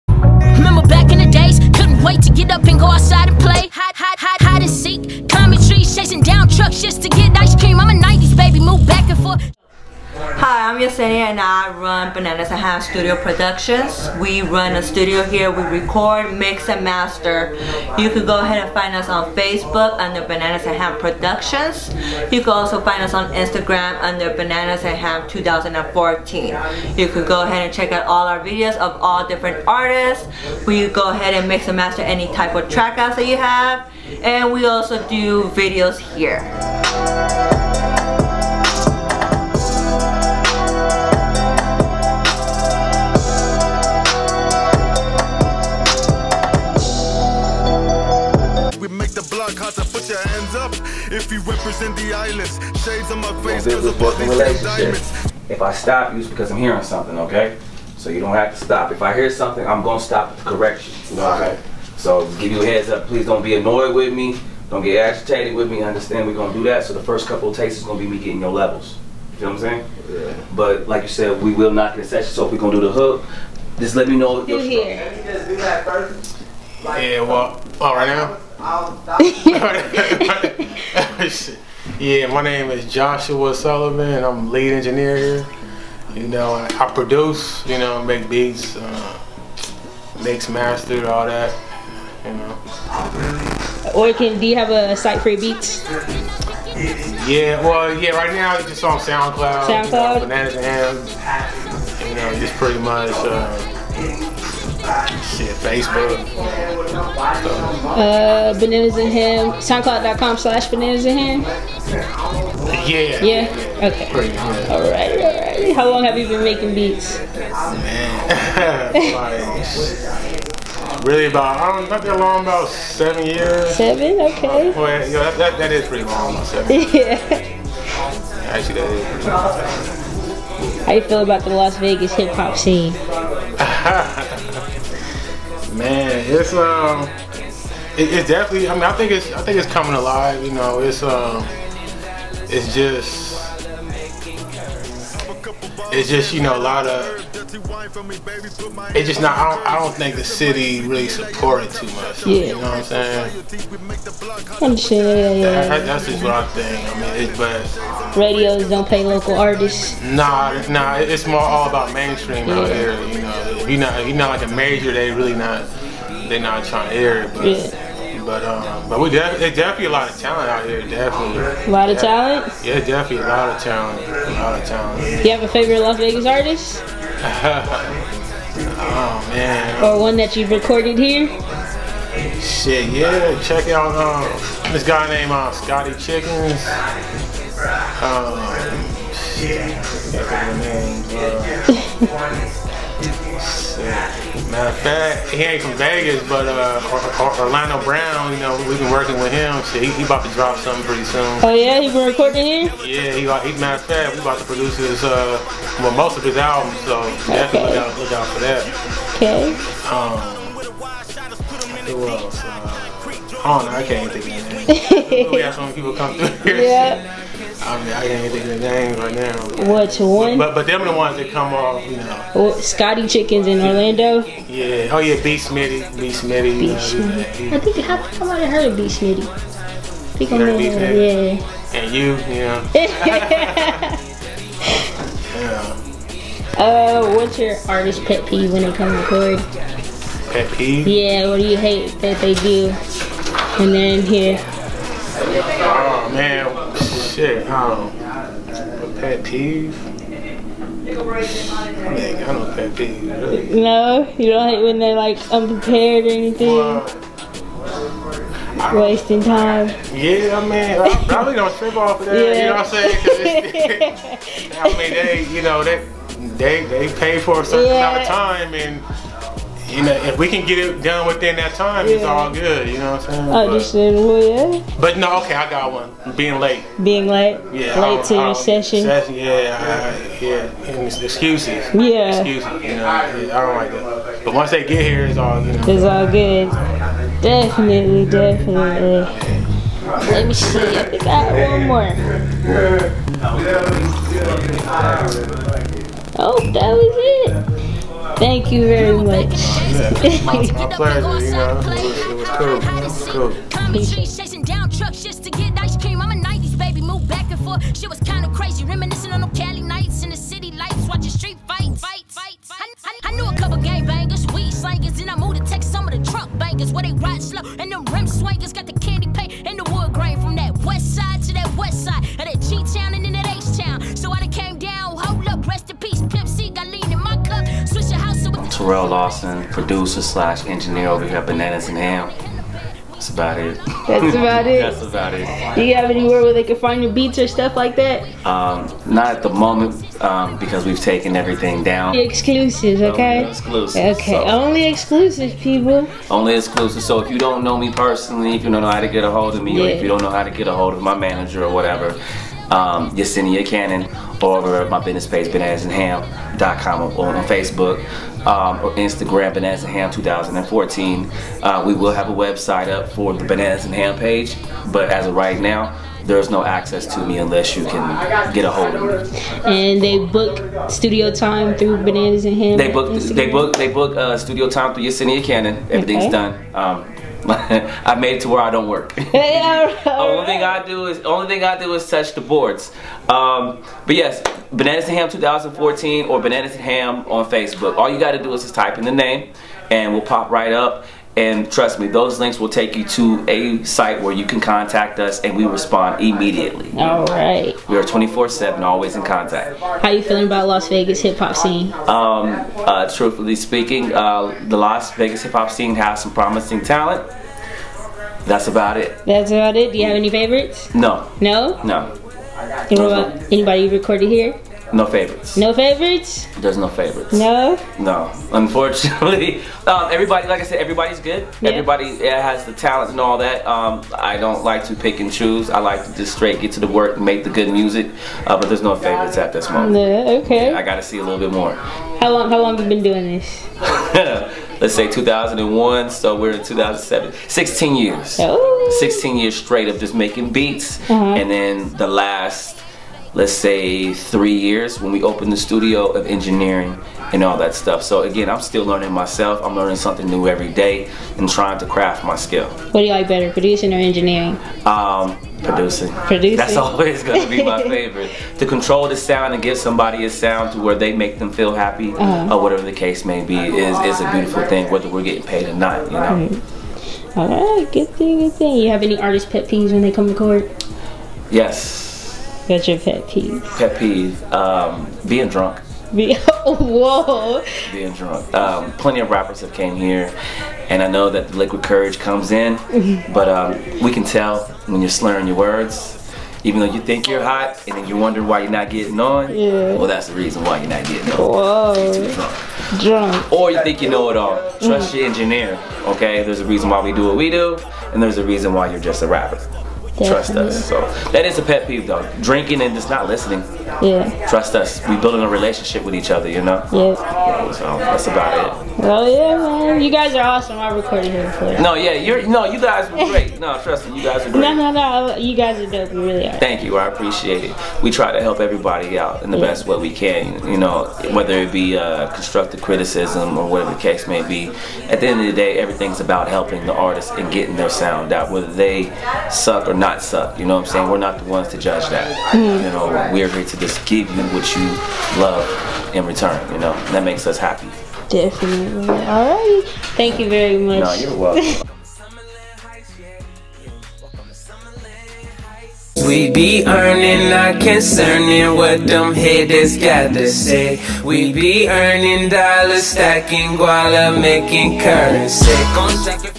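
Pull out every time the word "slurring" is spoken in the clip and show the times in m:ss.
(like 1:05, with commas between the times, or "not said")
8:04.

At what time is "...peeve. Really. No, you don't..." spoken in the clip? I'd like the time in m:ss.
4:12.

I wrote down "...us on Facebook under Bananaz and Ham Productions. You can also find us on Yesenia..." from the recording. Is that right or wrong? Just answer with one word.
wrong.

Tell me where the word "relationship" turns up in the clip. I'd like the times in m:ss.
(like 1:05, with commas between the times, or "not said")
8:25.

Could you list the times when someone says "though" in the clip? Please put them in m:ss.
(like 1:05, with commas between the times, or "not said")
8:06, 8:21.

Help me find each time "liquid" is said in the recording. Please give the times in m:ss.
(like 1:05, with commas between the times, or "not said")
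8:01.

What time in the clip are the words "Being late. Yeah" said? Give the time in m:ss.
4:36.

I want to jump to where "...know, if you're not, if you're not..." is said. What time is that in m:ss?
2:43.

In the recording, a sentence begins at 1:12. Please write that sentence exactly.
So if we're gonna do the hook, just let me know.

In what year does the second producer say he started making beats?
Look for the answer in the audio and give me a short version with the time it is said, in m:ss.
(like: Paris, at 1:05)
2001, at 7:14.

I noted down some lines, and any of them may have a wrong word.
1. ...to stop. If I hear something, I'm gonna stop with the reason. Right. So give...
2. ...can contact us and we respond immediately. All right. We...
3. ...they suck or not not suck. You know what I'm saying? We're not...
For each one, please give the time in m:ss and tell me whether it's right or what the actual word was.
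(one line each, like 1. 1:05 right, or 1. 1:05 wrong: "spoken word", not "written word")
1. 0:58 wrong: "correction", not "reason"
2. 6:34 right
3. 8:48 right.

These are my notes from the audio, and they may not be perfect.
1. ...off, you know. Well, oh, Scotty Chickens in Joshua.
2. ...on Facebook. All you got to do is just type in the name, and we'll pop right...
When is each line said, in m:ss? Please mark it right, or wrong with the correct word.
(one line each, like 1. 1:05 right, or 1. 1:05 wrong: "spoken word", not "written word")
1. 3:41 wrong: "Orlando", not "Joshua"
2. 6:27 right.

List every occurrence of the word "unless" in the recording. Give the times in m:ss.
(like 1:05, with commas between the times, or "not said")
6:07.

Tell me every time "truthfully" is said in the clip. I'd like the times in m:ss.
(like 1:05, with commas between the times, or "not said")
6:42.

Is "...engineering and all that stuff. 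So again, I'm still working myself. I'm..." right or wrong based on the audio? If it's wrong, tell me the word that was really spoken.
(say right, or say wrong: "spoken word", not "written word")
wrong: "learning", not "working".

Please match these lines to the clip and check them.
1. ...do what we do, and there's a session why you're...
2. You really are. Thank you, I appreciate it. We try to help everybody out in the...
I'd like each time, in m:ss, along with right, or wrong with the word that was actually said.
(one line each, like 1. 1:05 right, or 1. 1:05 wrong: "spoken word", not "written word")
1. 8:16 wrong: "reason", not "session"
2. 8:35 right.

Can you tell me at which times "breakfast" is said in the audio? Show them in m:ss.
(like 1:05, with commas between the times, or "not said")
not said.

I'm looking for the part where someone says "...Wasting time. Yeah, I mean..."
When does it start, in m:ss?
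4:18.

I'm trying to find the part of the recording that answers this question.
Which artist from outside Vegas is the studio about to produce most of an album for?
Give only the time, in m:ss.
3:17.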